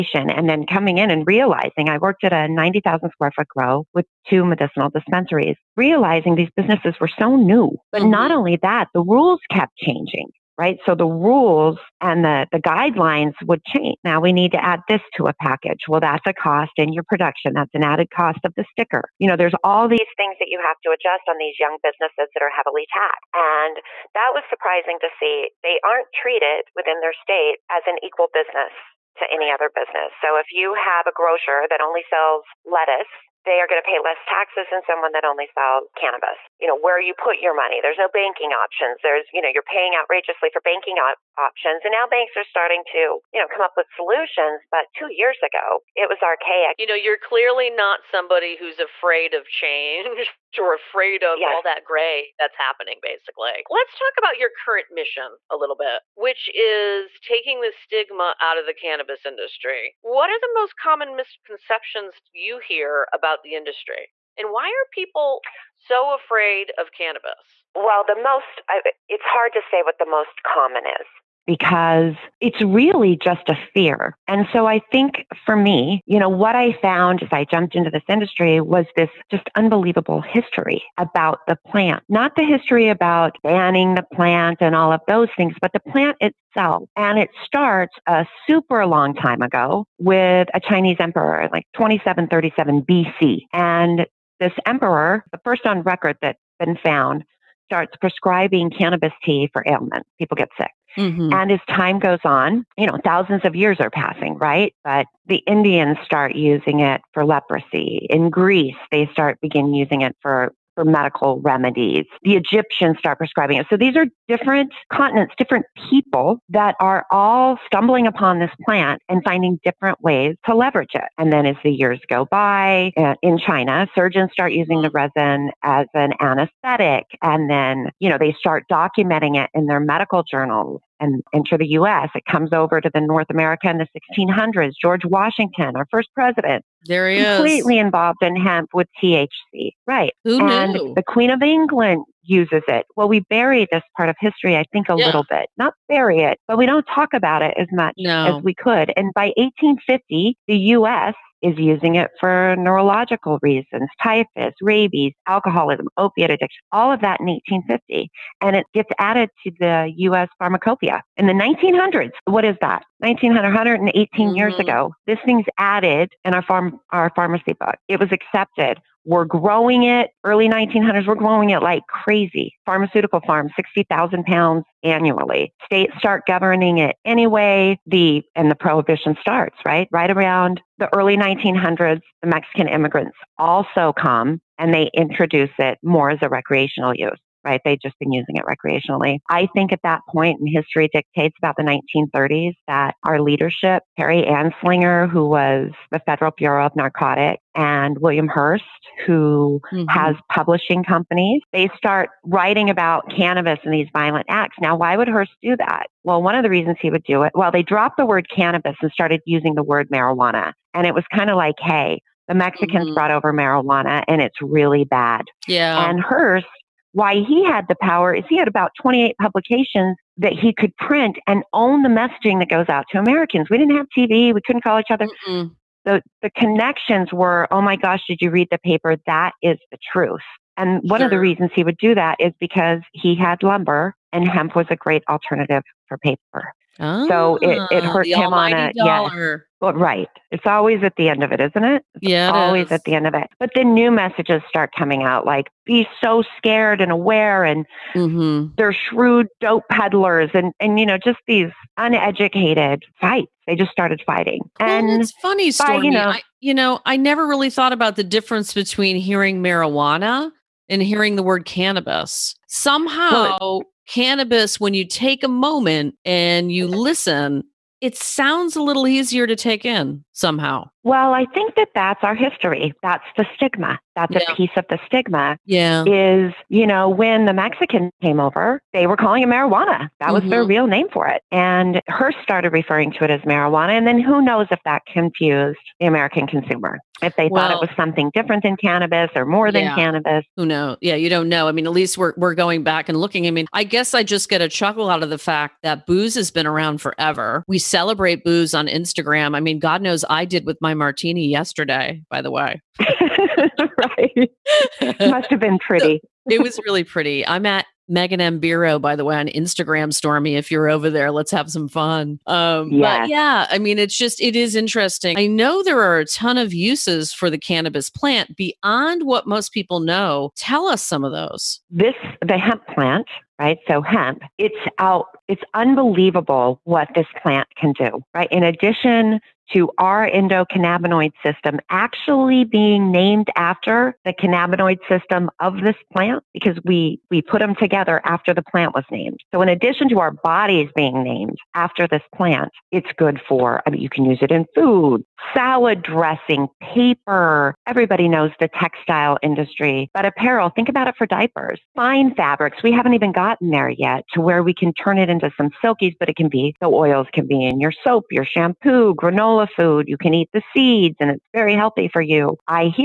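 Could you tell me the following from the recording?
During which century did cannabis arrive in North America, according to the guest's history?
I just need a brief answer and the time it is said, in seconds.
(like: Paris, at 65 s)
1600s, at 134 s.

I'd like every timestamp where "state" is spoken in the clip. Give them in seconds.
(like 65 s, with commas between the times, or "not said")
27 s, 175 s.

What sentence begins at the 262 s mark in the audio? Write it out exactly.
Somehow well, cannabis, when you take a moment and you listen, it sounds a little easier to take in somehow.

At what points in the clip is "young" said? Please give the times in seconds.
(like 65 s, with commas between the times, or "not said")
21 s.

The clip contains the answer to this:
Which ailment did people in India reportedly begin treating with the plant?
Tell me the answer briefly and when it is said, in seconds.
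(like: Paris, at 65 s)
Leprosy, at 107 s.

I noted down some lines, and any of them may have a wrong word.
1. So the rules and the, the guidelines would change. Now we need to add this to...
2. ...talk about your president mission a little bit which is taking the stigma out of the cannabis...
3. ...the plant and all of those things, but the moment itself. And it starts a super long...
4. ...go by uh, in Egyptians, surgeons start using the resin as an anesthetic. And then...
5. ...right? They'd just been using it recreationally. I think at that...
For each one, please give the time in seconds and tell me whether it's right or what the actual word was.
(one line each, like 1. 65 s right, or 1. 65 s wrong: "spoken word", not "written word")
1. 10 s right
2. 53 s wrong: "current", not "president"
3. 83 s wrong: "plant", not "moment"
4. 122 s wrong: "China", not "Egyptians"
5. 187 s right.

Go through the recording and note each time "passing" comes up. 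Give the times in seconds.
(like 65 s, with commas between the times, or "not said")
103 s.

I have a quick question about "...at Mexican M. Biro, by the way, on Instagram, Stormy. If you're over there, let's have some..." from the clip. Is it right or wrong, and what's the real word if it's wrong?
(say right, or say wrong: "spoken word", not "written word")
wrong: "Megan", not "Mexican".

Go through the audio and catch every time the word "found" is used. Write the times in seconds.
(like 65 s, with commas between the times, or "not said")
76 s, 96 s.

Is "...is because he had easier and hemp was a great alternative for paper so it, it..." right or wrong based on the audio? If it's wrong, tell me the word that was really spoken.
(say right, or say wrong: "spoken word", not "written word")
wrong: "lumber", not "easier".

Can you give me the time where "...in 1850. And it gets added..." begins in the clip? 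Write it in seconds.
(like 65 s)
157 s.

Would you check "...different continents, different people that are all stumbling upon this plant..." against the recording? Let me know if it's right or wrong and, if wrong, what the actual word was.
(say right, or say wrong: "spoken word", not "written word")
right.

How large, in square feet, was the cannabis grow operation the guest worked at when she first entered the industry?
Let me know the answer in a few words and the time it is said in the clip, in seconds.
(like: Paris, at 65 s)
90,000 square feet, at 2 s.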